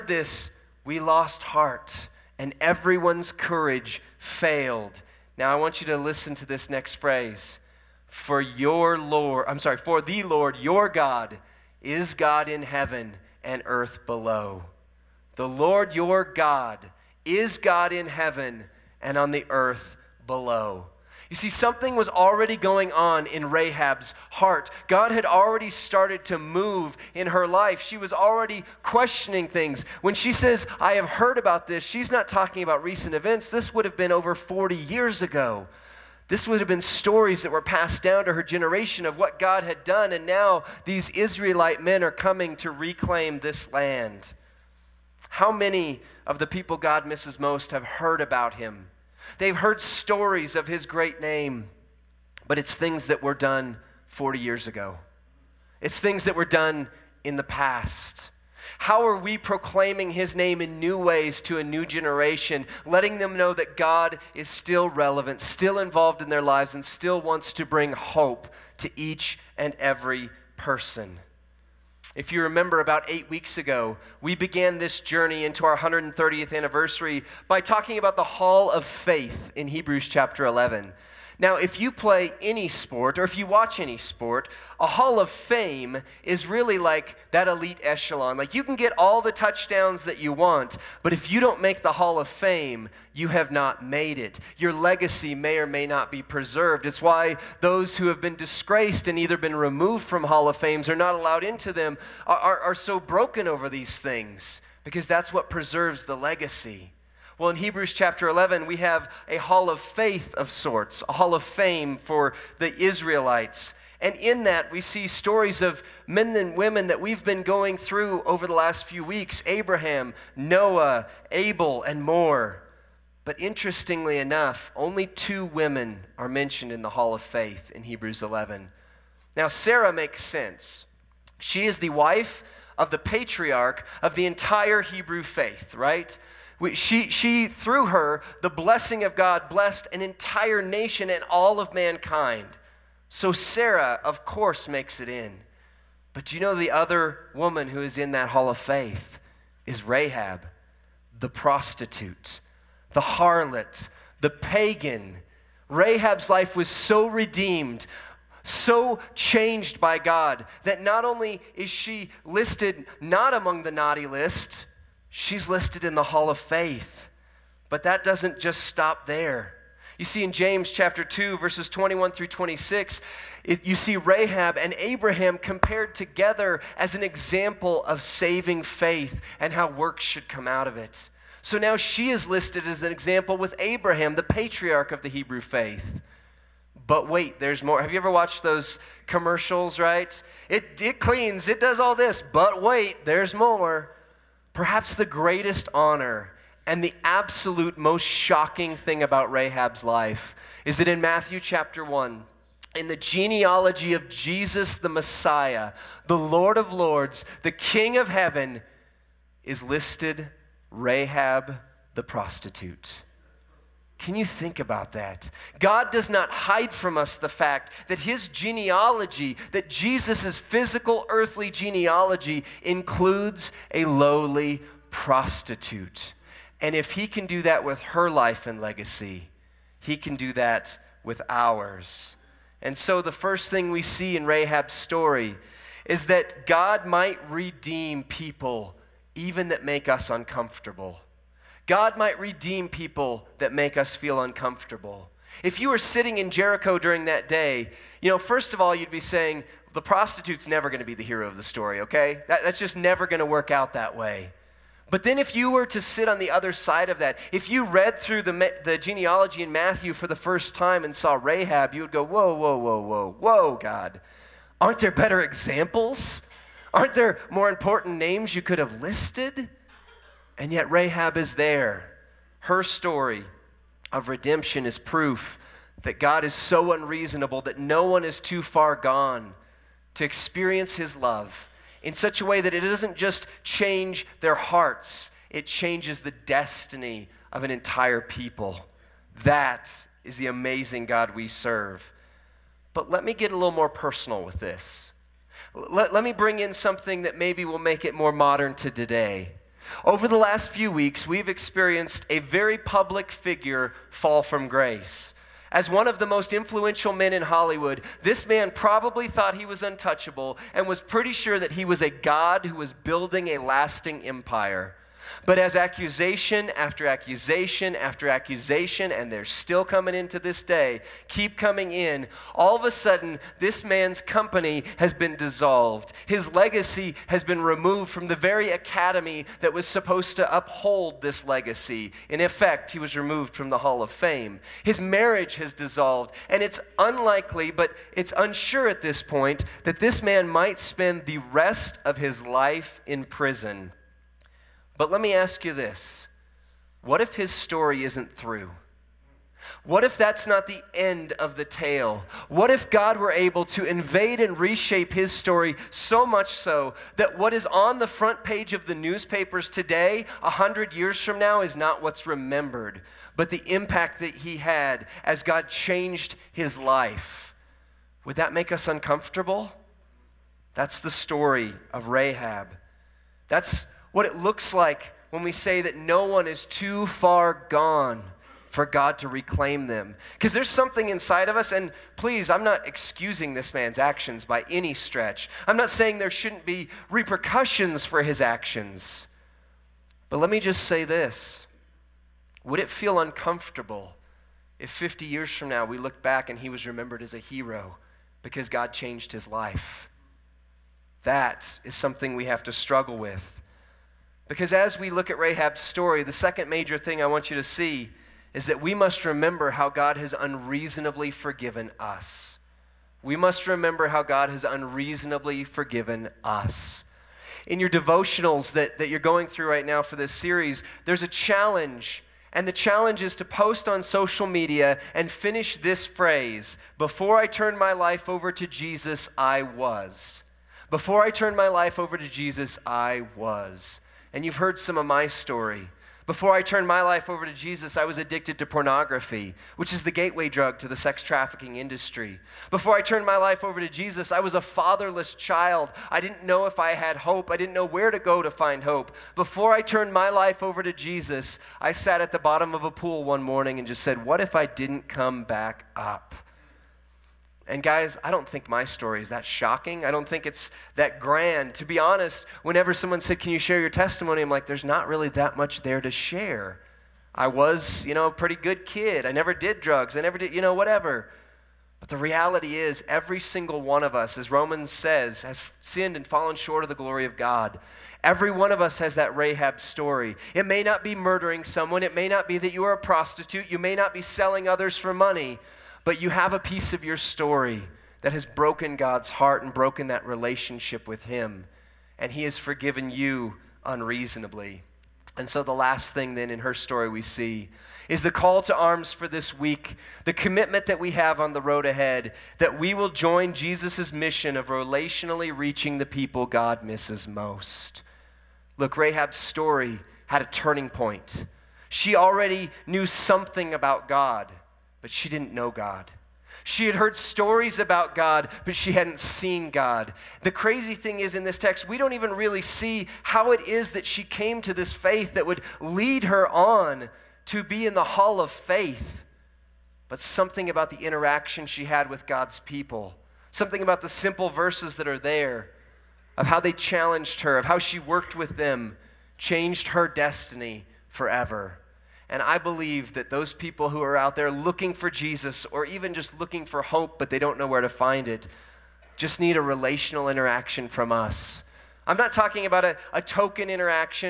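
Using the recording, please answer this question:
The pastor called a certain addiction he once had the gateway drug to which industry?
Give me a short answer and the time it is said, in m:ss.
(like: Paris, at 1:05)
sex trafficking industry, at 7:20.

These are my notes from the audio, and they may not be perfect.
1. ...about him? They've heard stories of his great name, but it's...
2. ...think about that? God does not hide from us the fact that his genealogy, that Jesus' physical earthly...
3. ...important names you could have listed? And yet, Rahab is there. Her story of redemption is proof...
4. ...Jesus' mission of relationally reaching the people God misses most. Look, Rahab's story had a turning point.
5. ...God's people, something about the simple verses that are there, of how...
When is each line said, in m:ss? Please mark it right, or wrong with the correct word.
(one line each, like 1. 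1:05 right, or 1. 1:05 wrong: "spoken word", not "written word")
1. 0:48 right
2. 3:34 right
3. 4:27 right
4. 8:23 right
5. 8:52 right.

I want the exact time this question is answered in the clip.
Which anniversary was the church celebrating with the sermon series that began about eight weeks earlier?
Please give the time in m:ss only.
1:15.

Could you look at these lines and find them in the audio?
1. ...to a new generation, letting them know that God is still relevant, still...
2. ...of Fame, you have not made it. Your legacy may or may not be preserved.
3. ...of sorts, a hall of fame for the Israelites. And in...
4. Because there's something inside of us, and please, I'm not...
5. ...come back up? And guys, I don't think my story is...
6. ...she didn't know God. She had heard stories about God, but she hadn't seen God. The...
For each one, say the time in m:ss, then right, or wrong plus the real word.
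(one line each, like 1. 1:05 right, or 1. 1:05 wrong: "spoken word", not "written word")
1. 1:01 right
2. 1:32 right
3. 1:50 right
4. 6:20 right
5. 7:34 right
6. 8:34 right.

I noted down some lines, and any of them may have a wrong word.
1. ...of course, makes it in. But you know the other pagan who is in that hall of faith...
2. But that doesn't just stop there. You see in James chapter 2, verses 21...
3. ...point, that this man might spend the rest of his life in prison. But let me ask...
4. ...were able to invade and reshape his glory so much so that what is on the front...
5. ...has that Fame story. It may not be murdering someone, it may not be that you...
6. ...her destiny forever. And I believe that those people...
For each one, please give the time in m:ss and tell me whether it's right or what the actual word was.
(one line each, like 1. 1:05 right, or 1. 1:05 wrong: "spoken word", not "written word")
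1. 2:24 wrong: "woman", not "pagan"
2. 2:47 right
3. 5:39 right
4. 5:52 wrong: "story", not "glory"
5. 7:58 wrong: "Rahab", not "Fame"
6. 8:59 right.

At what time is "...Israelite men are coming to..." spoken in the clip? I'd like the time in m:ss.
0:41.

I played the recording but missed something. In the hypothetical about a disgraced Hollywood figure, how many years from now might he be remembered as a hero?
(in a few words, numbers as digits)
50.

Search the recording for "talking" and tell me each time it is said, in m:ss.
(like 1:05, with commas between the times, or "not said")
0:32, 1:17, 9:12.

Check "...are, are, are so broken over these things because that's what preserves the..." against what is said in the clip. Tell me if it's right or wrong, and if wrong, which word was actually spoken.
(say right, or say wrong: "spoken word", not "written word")
right.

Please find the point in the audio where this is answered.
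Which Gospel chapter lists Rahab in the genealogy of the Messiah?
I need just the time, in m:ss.
3:21.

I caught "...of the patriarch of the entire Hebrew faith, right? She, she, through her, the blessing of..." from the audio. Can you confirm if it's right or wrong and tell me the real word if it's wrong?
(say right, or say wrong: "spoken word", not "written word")
right.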